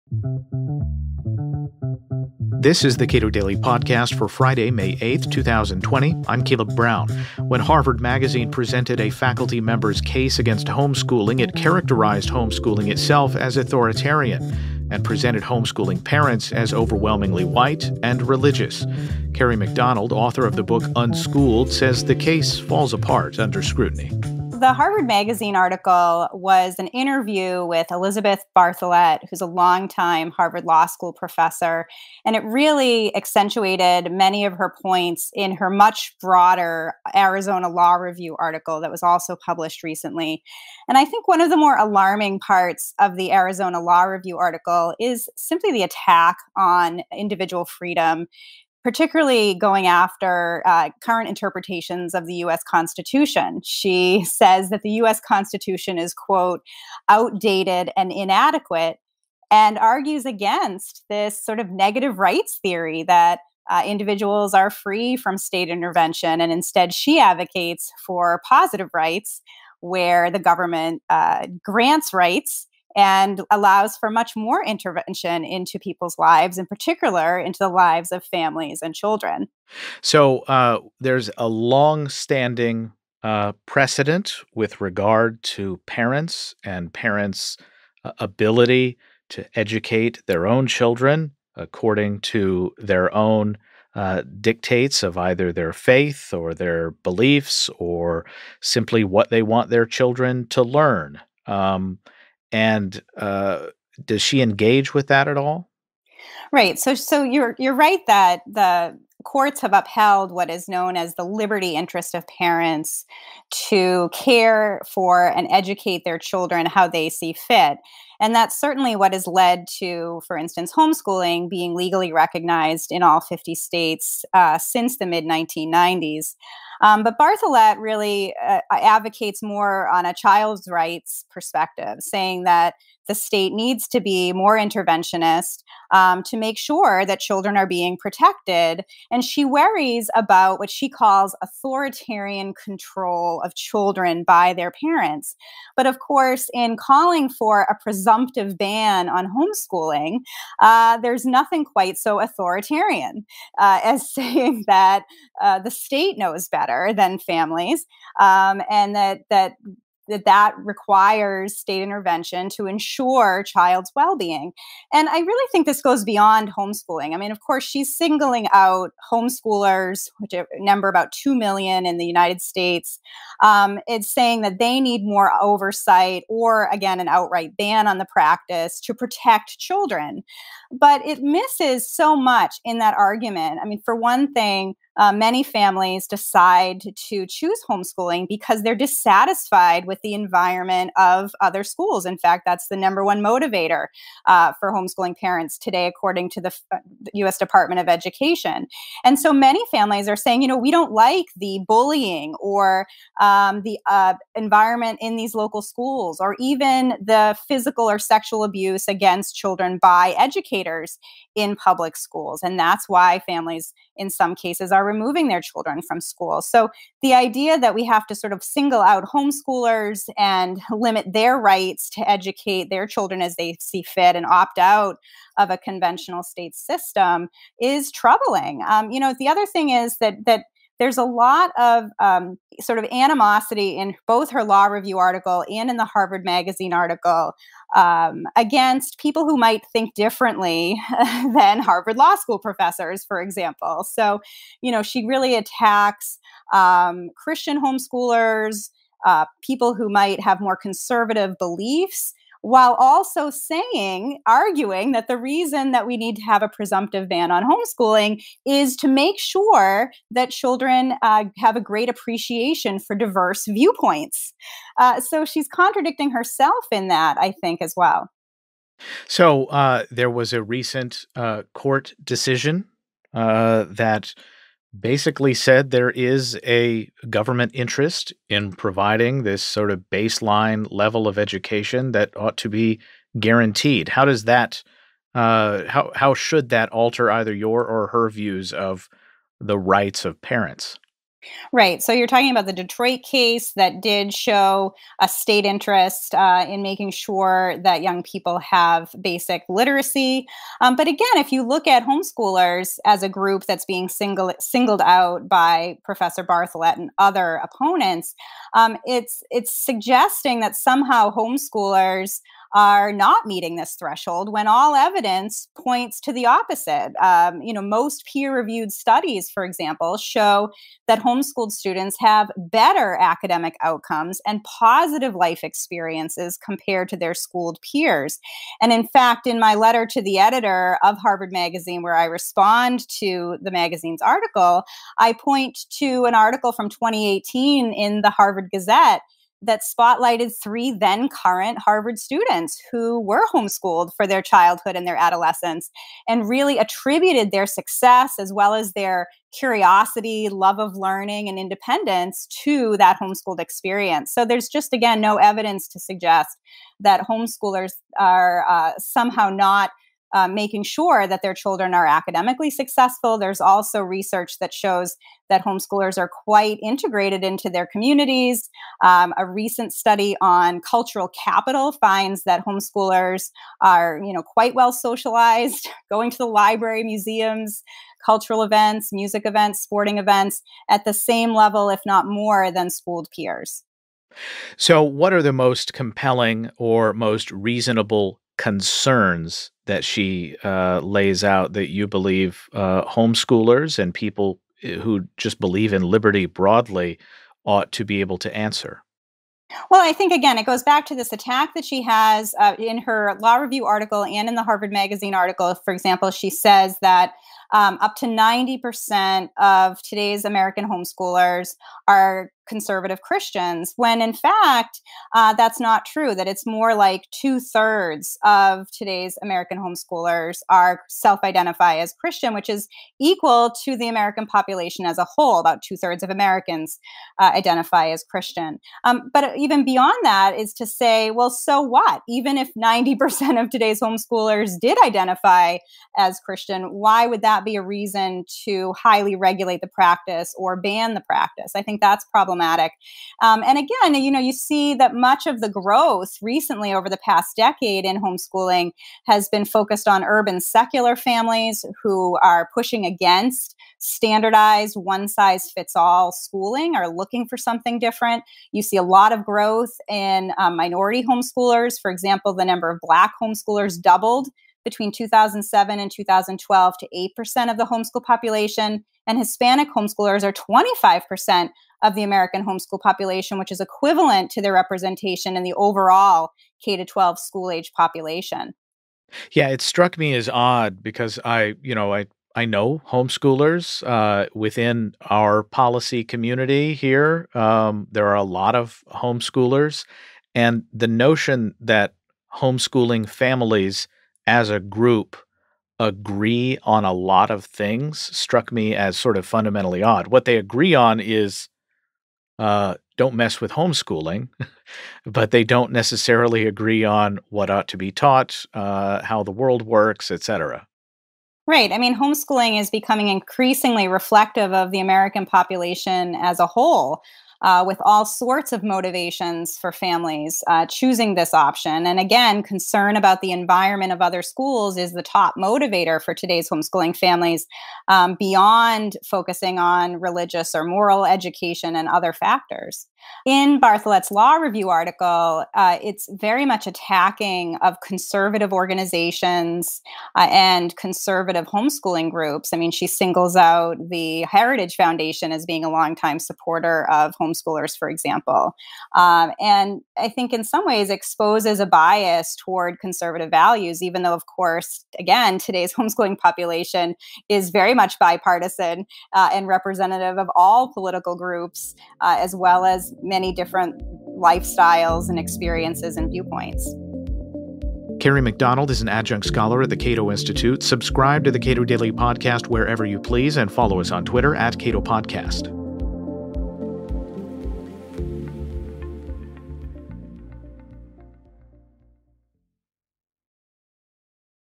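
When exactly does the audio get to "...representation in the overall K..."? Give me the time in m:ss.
7:54.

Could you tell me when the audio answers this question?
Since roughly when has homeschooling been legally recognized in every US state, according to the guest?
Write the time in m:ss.
2:05.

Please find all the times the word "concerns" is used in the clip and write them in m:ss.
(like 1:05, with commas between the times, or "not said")
6:28, 8:42.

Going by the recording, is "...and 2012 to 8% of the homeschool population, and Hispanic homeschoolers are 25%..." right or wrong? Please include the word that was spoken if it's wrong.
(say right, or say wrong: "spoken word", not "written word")
right.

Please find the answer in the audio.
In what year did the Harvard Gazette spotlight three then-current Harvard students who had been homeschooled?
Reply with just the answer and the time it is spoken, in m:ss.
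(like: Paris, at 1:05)
2018, at 5:36.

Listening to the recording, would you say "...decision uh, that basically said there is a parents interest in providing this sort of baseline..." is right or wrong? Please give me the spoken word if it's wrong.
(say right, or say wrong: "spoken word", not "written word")
wrong: "government", not "parents".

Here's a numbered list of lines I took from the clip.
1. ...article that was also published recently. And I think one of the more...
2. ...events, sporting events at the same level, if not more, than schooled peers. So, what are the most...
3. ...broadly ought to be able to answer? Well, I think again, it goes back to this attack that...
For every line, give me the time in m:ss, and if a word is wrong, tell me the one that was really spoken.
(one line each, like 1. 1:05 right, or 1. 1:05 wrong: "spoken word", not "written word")
1. 0:38 right
2. 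6:19 right
3. 6:36 right.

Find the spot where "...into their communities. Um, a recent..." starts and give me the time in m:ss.
6:07.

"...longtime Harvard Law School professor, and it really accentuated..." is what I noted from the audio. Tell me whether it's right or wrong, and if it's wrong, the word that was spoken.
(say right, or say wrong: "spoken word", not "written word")
right.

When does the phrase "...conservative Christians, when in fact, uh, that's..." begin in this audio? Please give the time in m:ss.
6:52.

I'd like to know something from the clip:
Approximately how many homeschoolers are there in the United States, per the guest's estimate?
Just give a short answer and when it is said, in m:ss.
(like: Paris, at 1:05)
2 million, at 2:51.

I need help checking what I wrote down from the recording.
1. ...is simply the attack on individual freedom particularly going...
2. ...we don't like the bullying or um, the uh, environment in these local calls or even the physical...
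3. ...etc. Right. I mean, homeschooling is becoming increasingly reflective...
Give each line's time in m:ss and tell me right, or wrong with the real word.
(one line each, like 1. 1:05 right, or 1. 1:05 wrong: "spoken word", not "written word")
1. 0:44 right
2. 3:20 wrong: "schools", not "calls"
3. 8:30 right.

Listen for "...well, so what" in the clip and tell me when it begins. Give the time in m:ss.
7:11.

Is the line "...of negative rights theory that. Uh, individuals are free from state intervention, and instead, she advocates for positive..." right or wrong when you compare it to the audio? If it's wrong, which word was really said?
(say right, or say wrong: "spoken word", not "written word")
right.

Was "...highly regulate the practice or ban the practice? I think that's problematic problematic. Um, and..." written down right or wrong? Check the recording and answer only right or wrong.
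right.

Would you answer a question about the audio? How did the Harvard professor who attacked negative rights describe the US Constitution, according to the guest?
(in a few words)
outdated and inadequate.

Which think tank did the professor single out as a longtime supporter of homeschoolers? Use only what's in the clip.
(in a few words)
Heritage Foundation.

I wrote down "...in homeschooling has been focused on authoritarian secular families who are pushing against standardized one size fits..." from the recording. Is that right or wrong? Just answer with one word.
wrong.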